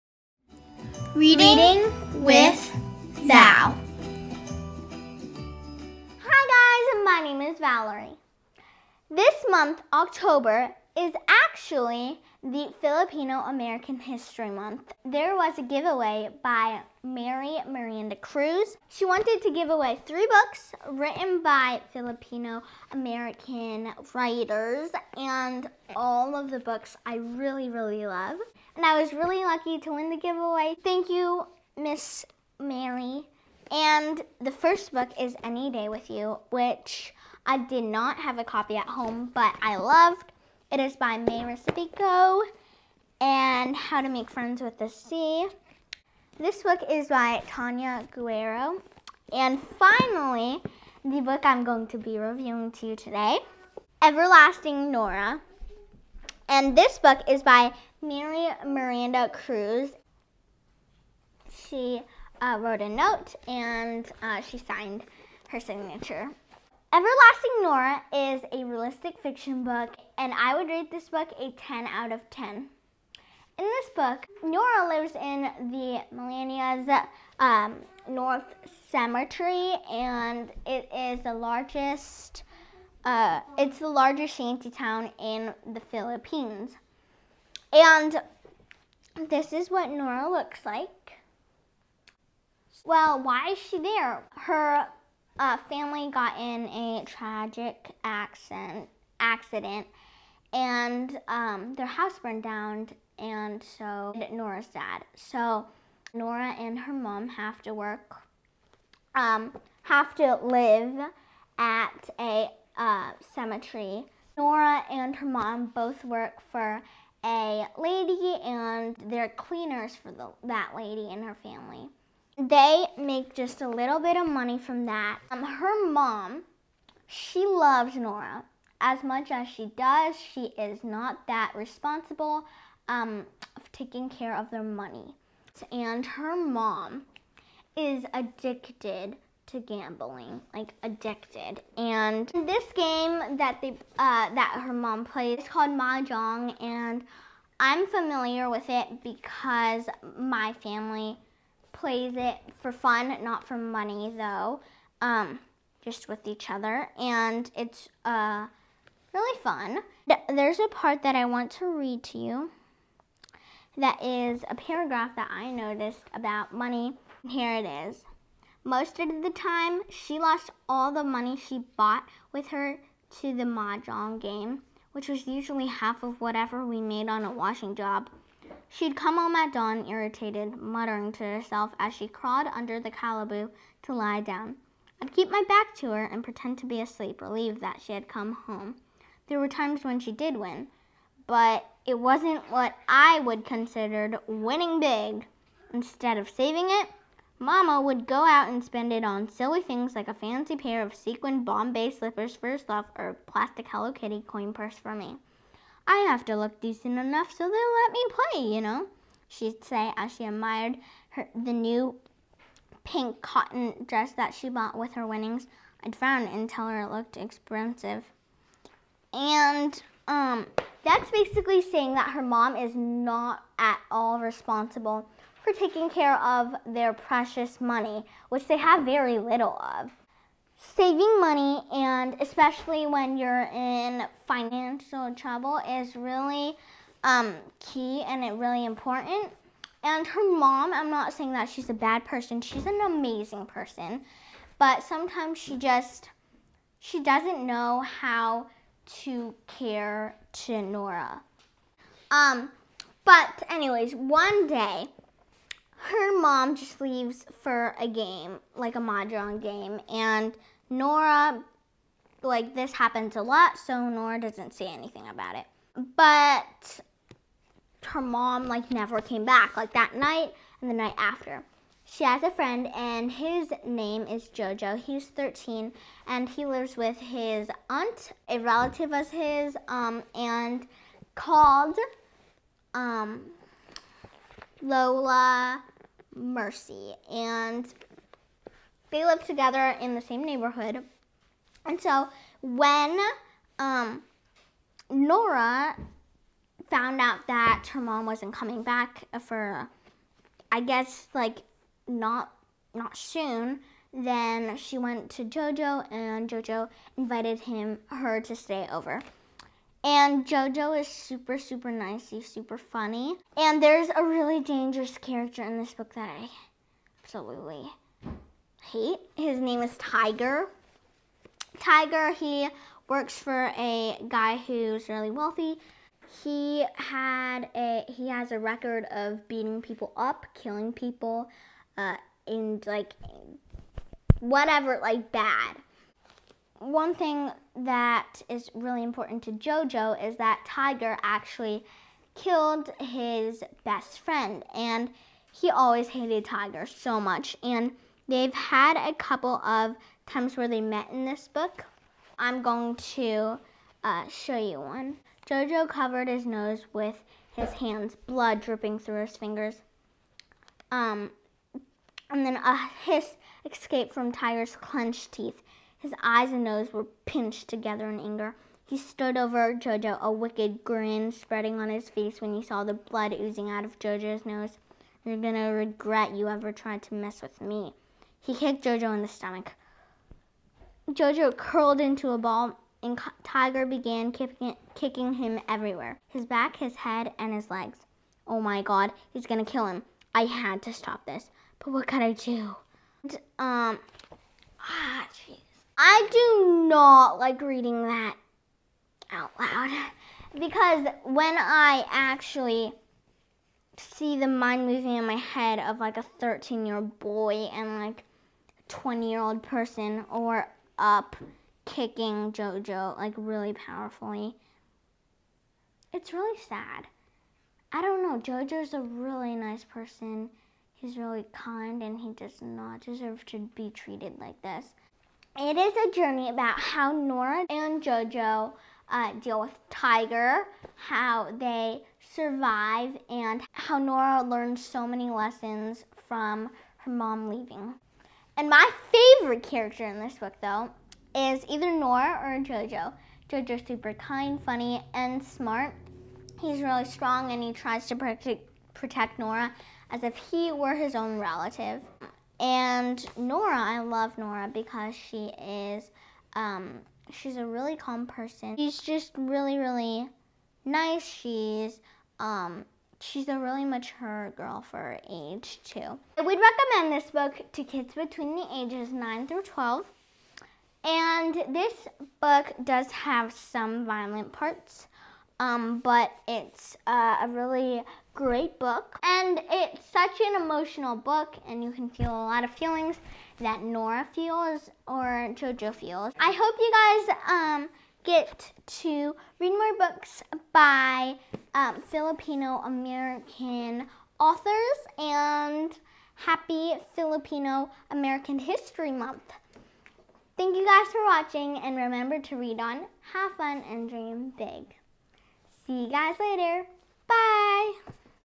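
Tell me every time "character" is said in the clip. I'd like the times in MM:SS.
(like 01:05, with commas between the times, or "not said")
05:14, 07:19.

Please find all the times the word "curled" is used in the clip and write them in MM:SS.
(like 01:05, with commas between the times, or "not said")
06:21.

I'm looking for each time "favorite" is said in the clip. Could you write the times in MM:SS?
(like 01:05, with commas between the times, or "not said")
07:18.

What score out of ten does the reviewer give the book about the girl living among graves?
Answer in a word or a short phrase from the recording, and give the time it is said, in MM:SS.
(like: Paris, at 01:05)
10 out of 10, at 01:11.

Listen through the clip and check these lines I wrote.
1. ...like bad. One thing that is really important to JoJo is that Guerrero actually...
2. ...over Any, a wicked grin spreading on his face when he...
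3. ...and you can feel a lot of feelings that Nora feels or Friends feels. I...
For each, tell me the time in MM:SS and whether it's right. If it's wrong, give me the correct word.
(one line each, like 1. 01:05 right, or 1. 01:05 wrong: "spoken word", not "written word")
1. 05:34 wrong: "Tiger", not "Guerrero"
2. 06:09 wrong: "Jojo", not "Any"
3. 08:01 wrong: "JoJo", not "Friends".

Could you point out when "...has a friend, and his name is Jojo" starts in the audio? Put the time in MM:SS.
04:32.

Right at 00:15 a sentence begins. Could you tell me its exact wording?
There was a giveaway by Marie Miranda Cruz.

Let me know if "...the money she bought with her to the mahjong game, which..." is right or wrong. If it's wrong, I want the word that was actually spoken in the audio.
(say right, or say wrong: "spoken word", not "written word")
right.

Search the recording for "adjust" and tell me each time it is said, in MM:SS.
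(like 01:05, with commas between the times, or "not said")
not said.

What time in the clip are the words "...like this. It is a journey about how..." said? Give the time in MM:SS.
07:04.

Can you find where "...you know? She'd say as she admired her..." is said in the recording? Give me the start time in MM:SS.
03:28.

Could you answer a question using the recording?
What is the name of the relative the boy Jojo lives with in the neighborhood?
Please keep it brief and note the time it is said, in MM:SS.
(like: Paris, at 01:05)
Lola Mercy, at 04:44.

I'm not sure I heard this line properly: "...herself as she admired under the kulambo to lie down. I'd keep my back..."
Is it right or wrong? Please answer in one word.
wrong.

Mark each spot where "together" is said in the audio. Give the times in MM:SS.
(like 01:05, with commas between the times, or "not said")
04:49, 06:07.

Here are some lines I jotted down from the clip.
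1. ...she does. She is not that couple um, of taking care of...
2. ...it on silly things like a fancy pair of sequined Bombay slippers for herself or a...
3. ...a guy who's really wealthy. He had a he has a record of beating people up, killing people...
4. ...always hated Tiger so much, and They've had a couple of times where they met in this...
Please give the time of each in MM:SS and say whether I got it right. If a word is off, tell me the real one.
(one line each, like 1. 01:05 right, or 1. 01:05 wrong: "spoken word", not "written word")
1. 02:09 wrong: "responsible", not "couple"
2. 03:18 right
3. 05:23 right
4. 05:45 right.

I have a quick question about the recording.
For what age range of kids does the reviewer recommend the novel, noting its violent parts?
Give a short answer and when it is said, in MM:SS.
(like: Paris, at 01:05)
9 through 12, at 07:48.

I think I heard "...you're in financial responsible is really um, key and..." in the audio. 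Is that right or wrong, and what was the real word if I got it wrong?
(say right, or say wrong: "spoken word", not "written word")
wrong: "trouble", not "responsible".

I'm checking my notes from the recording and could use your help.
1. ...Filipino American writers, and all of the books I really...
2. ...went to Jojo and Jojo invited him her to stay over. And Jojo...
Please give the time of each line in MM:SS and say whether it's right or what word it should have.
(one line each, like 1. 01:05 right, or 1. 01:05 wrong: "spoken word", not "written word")
1. 00:21 right
2. 05:04 right.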